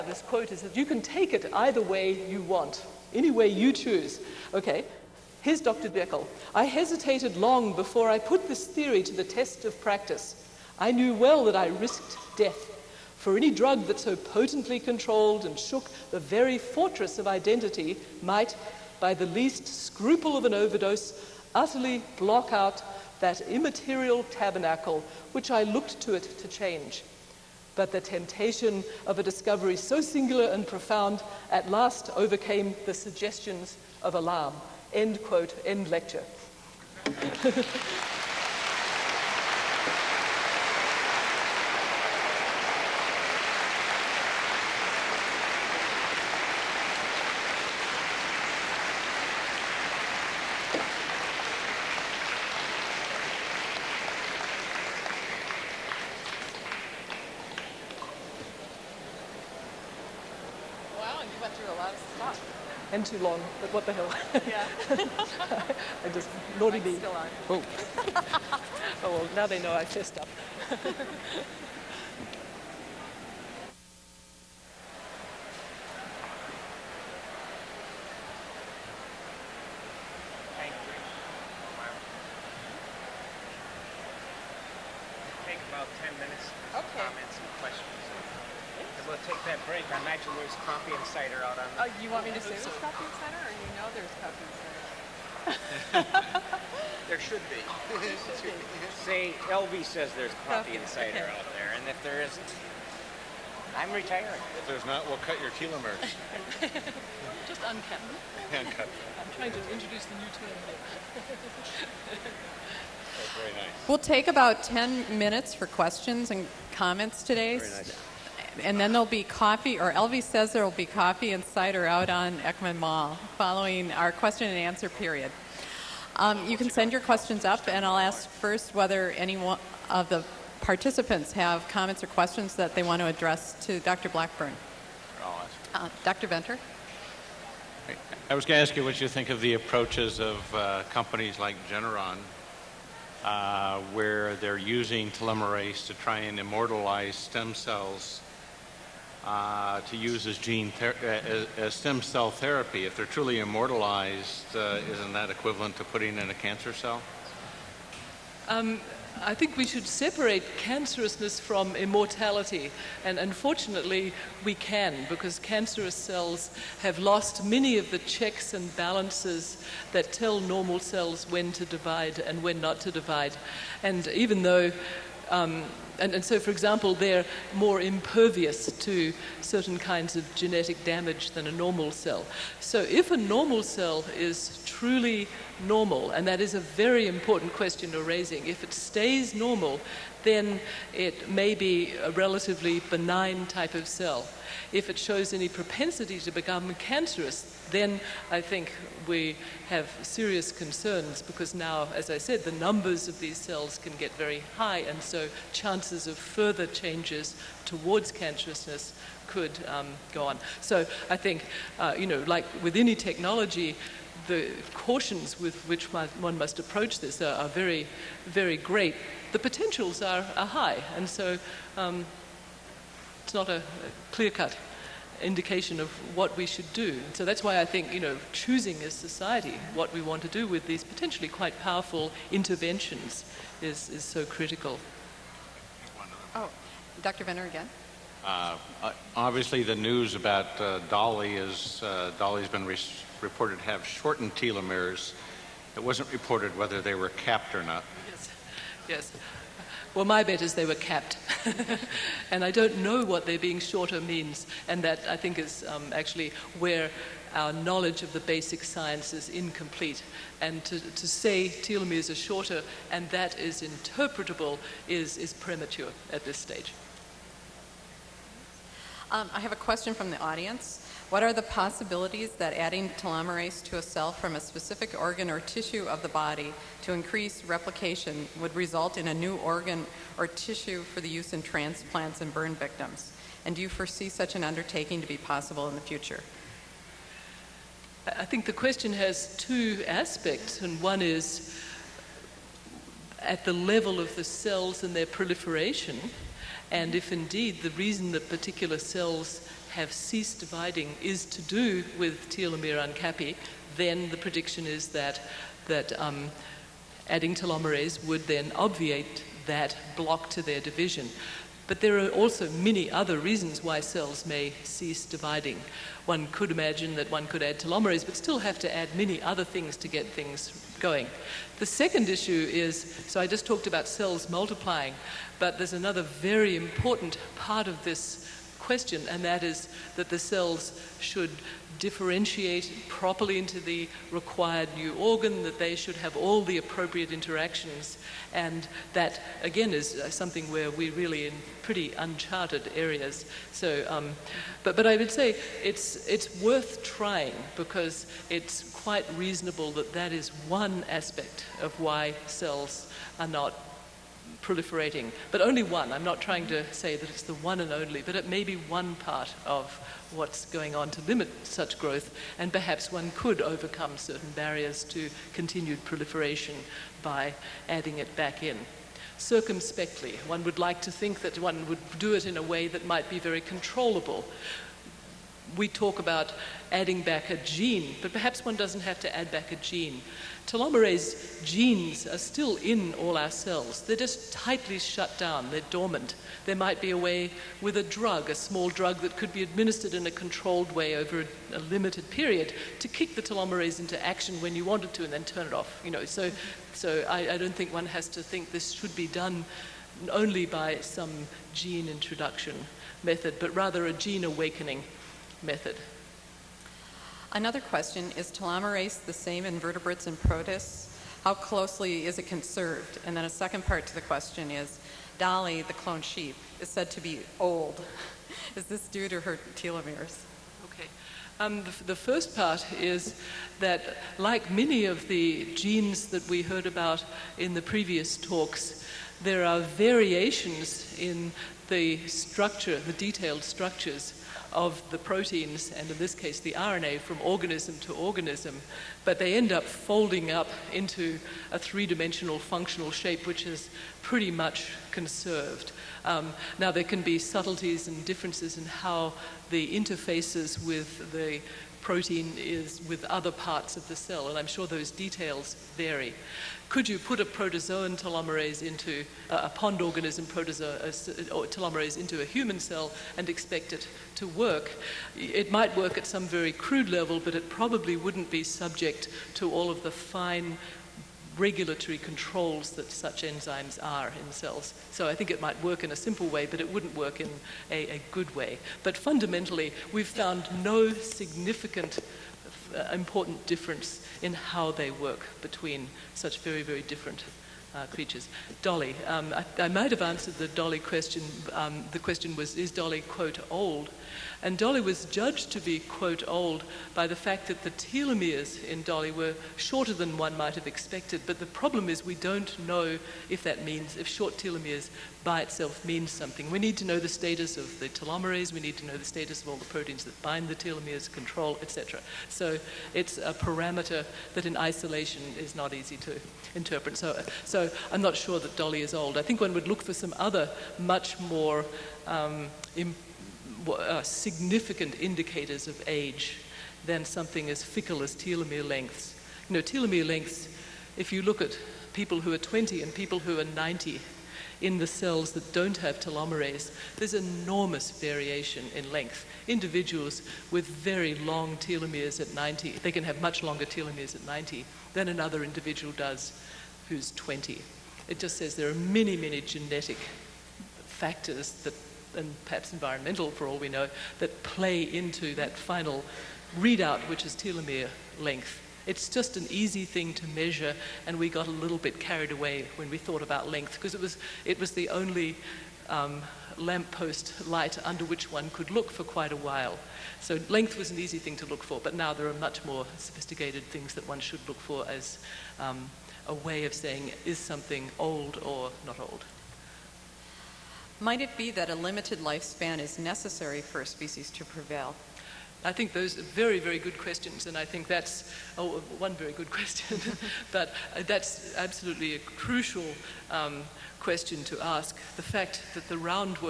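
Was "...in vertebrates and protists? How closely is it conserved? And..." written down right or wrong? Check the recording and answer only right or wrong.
right.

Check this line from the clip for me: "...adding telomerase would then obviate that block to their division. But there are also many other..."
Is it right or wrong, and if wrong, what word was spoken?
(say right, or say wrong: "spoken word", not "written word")
right.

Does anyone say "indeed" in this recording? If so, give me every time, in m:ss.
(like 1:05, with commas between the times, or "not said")
4:57.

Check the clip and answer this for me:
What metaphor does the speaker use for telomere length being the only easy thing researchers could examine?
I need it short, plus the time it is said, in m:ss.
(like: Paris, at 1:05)
lamppost light, at 9:26.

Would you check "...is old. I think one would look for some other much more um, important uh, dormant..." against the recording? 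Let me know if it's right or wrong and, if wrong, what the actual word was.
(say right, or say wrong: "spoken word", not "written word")
wrong: "significant", not "dormant".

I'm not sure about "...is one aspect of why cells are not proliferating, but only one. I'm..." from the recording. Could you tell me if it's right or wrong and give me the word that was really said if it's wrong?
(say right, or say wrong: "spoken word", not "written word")
right.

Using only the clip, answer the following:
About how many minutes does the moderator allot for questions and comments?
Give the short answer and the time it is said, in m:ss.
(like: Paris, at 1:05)
10, at 1:54.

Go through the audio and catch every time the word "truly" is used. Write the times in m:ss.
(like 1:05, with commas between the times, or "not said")
2:33, 3:04.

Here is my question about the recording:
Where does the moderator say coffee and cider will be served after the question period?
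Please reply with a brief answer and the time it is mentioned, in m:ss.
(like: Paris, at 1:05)
Eckman Mall, at 2:02.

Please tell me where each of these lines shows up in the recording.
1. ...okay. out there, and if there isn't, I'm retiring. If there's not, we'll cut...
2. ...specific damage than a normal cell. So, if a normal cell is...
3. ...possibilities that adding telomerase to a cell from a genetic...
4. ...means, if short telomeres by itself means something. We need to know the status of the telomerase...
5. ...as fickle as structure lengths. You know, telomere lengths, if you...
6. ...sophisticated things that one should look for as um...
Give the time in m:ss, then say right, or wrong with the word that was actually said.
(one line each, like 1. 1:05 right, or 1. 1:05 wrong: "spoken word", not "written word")
1. 1:41 right
2. 3:00 wrong: "genetic", not "specific"
3. 4:31 wrong: "specific", not "genetic"
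4. 8:23 right
5. 8:47 wrong: "telomere", not "structure"
6. 9:32 right.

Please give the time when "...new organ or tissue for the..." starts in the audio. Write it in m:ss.
4:39.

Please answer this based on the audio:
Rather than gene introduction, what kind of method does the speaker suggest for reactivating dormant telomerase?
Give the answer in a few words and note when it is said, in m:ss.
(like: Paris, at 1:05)
gene awakening method, at 6:43.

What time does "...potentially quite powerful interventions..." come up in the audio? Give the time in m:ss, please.
3:50.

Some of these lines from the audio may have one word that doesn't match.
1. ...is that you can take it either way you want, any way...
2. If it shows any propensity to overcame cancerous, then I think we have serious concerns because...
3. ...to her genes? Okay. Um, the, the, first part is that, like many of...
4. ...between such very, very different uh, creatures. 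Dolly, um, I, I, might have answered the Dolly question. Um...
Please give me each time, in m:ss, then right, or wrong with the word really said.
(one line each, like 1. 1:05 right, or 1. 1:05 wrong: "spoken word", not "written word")
1. 0:00 right
2. 3:14 wrong: "become", not "overcame"
3. 6:59 wrong: "telomeres", not "genes"
4. 8:05 right.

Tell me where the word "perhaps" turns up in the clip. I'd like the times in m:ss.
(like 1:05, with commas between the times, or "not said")
6:02, 6:18, 9:12.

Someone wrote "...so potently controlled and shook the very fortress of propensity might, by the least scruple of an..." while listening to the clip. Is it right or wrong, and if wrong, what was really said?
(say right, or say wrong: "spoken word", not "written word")
wrong: "identity", not "propensity".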